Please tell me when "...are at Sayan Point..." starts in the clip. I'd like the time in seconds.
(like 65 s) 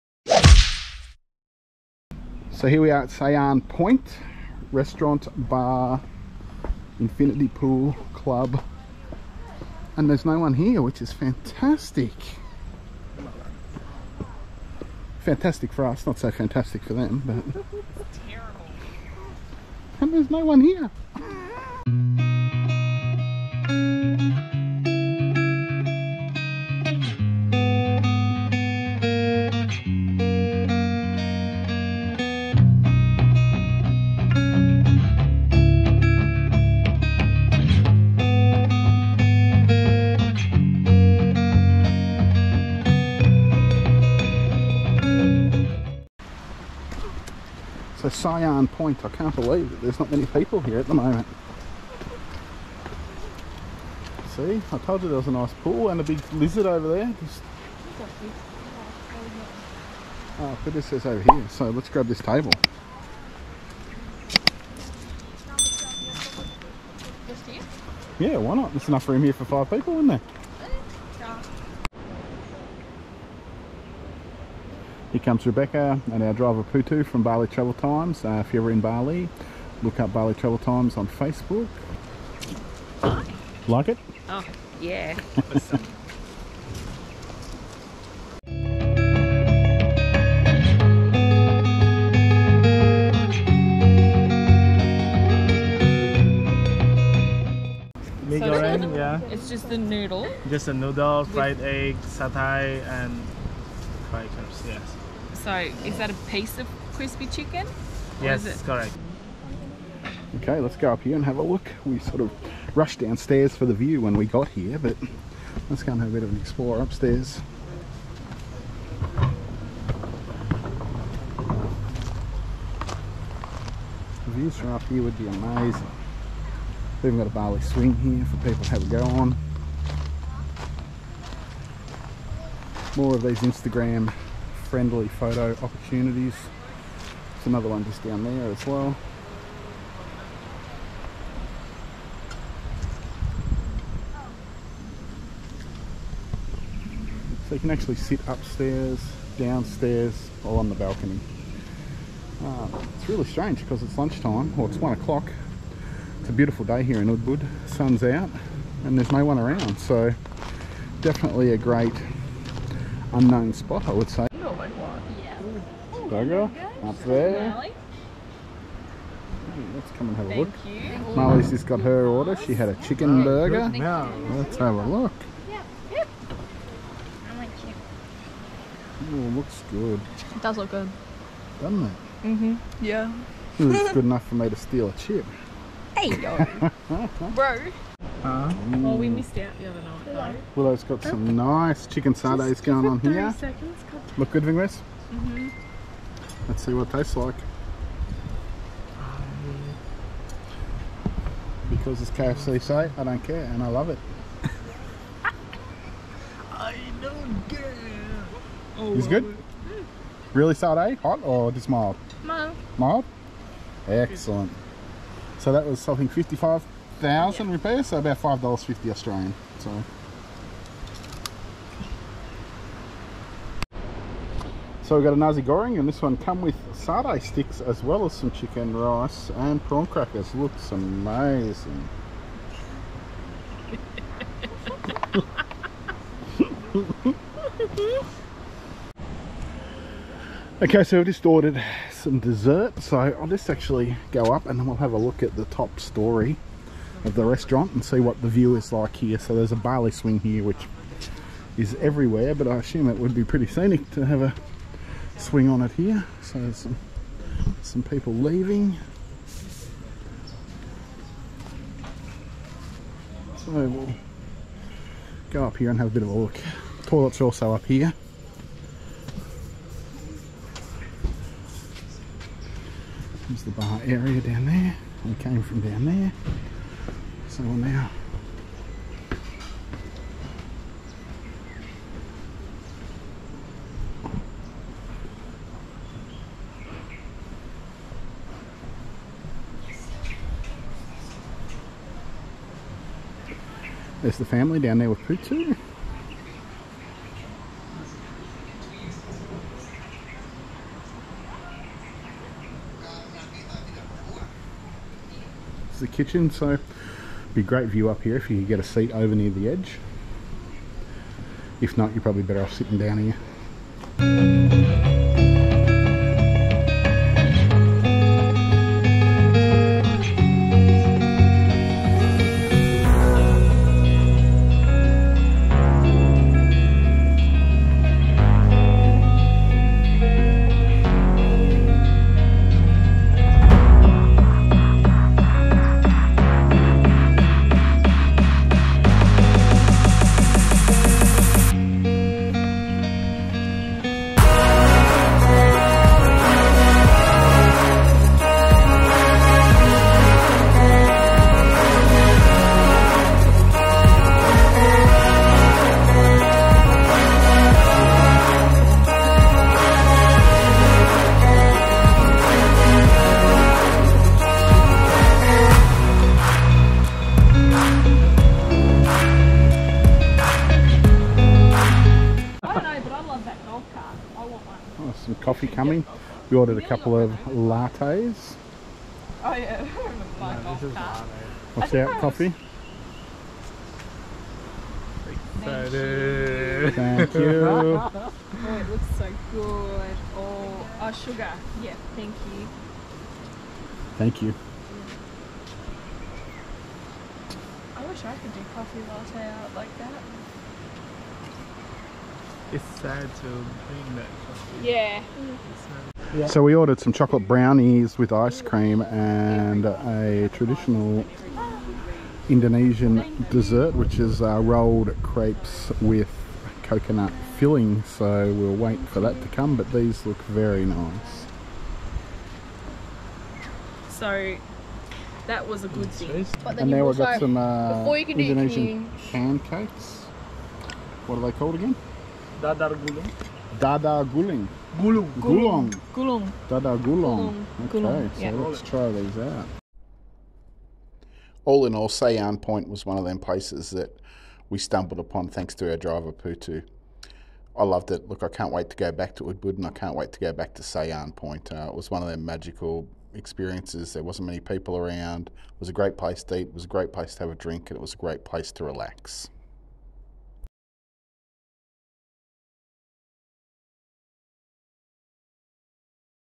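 2 s.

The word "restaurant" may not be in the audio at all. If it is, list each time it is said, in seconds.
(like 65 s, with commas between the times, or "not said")
4 s, 247 s.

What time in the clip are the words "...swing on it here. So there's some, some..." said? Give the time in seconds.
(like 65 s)
255 s.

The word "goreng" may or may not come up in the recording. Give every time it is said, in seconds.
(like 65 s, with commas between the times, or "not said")
98 s, 225 s.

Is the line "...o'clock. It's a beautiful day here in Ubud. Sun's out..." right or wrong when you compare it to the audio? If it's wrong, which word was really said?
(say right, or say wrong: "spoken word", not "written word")
right.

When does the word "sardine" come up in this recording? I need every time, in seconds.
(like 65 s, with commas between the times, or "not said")
192 s, 210 s, 226 s.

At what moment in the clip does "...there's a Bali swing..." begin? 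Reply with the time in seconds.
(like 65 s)
249 s.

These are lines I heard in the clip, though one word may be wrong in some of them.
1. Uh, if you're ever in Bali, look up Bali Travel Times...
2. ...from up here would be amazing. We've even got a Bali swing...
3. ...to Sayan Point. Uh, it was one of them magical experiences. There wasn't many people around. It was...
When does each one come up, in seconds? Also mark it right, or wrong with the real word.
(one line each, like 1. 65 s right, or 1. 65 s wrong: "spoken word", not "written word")
1. 78 s right
2. 124 s right
3. 450 s right.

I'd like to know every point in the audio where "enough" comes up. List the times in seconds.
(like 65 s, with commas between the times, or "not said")
68 s, 184 s.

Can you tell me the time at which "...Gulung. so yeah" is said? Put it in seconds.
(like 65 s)
437 s.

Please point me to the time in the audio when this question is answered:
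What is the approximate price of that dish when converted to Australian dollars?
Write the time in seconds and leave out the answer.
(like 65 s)
218 s.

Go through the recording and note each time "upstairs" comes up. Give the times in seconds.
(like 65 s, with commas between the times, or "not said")
116 s, 148 s.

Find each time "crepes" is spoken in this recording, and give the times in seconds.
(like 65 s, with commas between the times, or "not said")
415 s.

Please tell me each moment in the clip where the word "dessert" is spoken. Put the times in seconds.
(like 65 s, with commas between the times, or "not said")
242 s, 413 s.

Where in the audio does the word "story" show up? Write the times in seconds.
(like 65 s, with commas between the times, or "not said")
245 s.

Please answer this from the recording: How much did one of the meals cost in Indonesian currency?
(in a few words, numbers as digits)
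55,000 rupiahs.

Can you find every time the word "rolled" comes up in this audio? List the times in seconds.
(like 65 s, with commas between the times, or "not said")
414 s.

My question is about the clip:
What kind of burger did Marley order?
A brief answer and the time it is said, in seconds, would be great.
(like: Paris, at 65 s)
Chicken burger, at 172 s.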